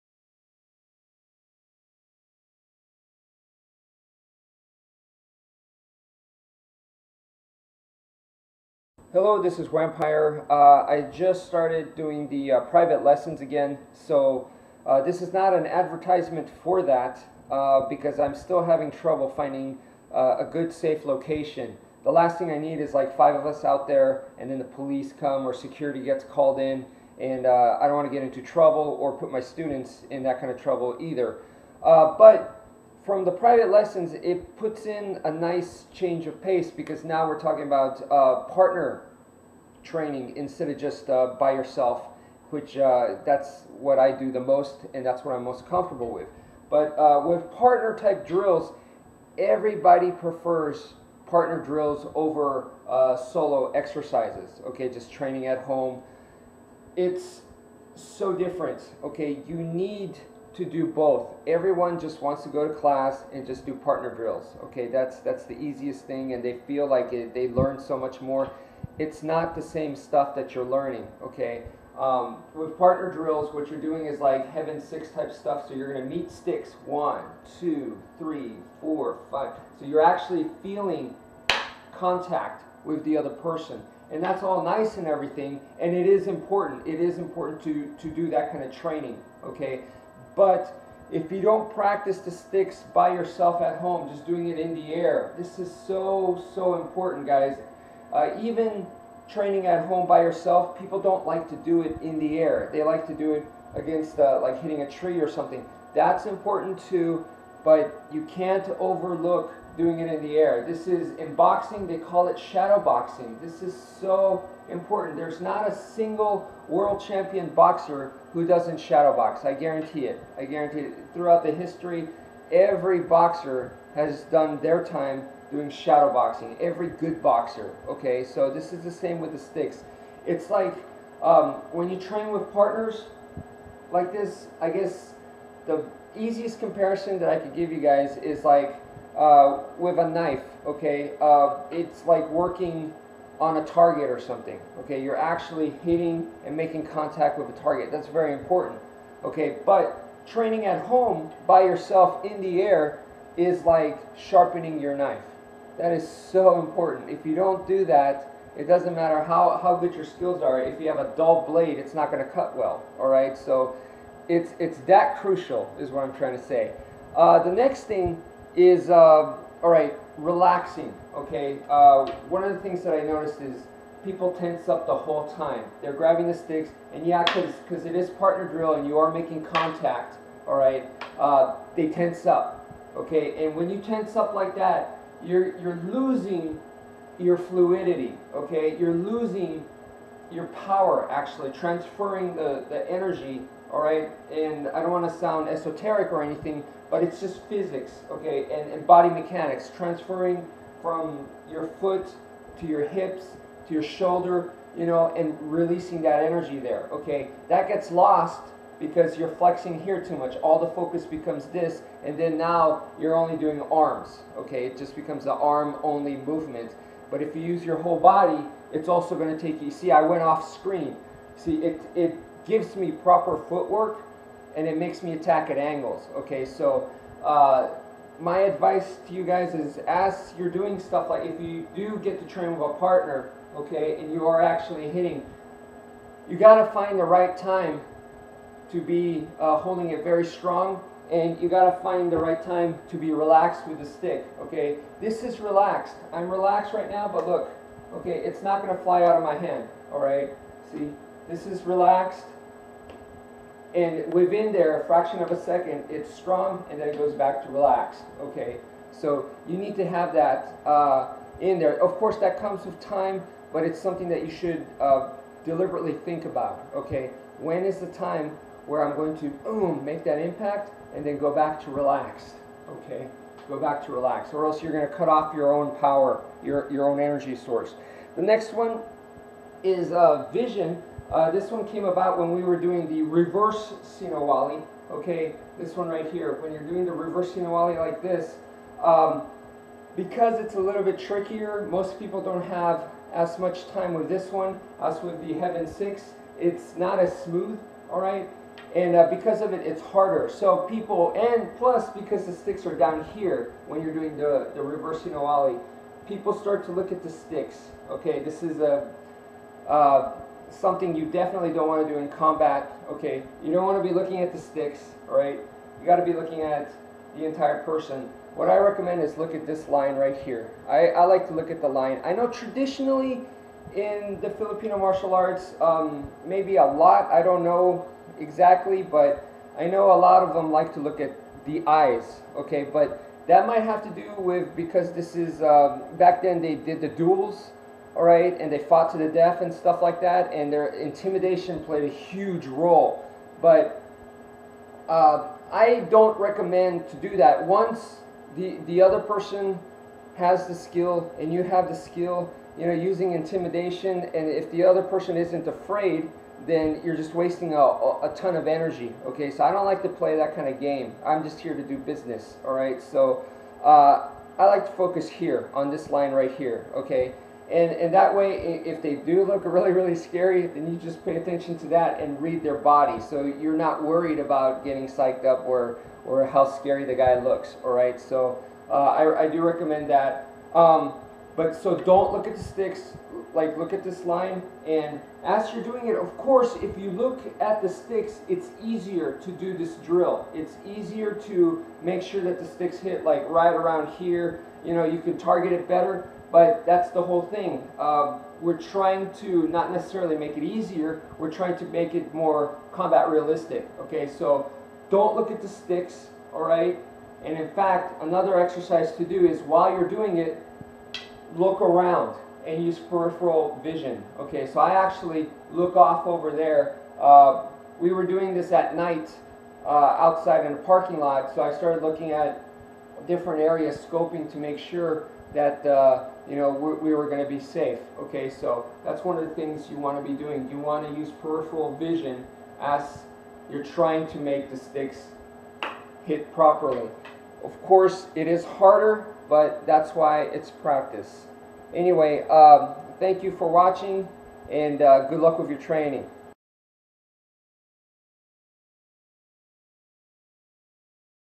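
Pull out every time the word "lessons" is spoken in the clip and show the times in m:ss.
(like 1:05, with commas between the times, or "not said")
0:13, 0:33.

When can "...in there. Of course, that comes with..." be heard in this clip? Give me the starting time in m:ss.
4:21.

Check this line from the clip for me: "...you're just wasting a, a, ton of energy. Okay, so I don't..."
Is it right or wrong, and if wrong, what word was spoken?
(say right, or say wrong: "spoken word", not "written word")
right.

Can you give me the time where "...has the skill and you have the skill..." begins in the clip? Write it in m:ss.
5:50.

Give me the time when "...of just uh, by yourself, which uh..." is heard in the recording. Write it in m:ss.
0:40.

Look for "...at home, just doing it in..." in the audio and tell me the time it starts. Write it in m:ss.
1:33.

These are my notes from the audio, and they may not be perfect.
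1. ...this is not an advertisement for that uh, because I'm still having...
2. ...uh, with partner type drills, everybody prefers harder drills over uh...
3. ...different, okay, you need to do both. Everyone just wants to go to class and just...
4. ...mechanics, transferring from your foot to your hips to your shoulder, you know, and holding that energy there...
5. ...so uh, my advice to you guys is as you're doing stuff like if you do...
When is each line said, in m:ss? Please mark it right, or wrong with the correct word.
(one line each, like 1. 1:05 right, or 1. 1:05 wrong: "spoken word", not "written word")
1. 0:15 right
2. 0:46 wrong: "partner", not "harder"
3. 0:58 right
4. 3:19 wrong: "releasing", not "holding"
5. 3:46 right.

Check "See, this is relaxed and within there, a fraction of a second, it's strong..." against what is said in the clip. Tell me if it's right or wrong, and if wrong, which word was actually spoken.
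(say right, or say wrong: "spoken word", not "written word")
right.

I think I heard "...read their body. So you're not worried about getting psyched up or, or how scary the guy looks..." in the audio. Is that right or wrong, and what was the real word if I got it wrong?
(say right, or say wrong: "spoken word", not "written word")
right.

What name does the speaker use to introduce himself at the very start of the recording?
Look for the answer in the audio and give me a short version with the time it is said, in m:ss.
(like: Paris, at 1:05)
Vampire, at 0:09.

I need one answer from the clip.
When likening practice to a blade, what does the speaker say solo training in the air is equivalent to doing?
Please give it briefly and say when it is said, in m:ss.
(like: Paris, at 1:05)
Sharpening your knife, at 2:34.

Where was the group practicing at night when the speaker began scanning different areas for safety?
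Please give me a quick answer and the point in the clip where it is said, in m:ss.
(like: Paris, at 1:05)
A parking lot, at 7:00.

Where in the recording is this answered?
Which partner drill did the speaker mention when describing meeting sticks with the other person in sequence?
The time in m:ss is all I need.
1:14.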